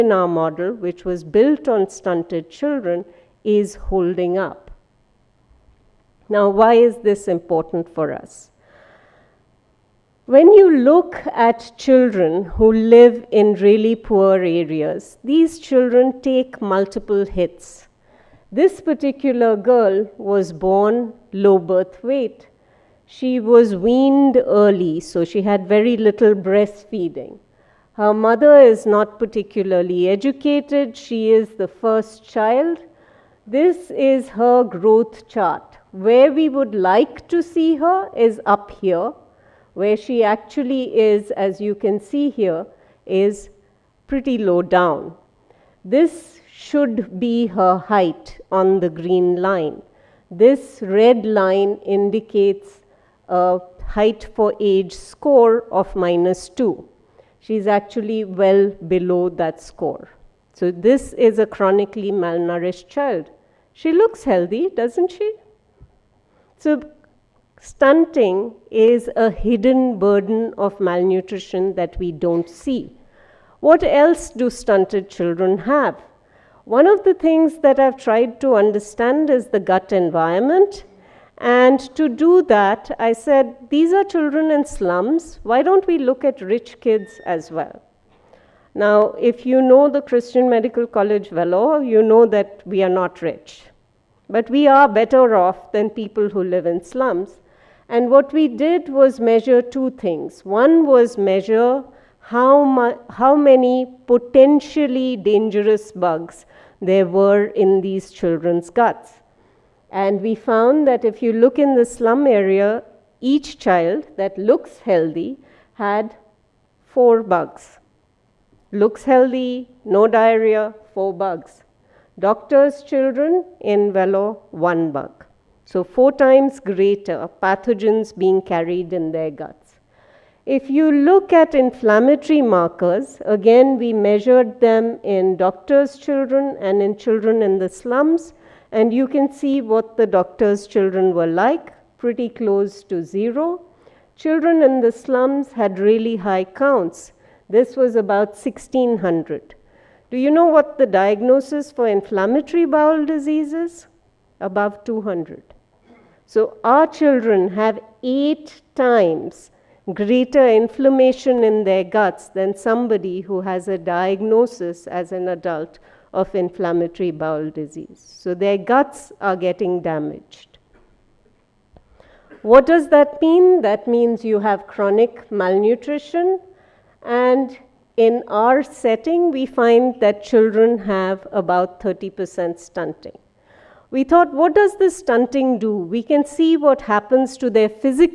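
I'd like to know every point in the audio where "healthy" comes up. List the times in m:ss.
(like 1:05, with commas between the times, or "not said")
1:04, 1:54, 1:59.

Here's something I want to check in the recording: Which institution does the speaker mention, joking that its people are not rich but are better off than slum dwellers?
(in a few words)
Christian Medical College.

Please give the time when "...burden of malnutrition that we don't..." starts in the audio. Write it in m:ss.
1:09.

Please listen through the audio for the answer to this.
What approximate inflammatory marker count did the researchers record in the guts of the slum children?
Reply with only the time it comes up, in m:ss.
2:28.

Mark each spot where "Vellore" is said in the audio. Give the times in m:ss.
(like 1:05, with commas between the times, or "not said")
1:31, 2:03.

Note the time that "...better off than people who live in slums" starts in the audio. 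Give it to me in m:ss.
1:34.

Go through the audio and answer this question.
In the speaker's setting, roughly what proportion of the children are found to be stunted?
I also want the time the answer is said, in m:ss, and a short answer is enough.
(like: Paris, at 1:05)
30%, at 3:01.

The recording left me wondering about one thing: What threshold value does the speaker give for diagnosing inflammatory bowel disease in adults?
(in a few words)
Above 200.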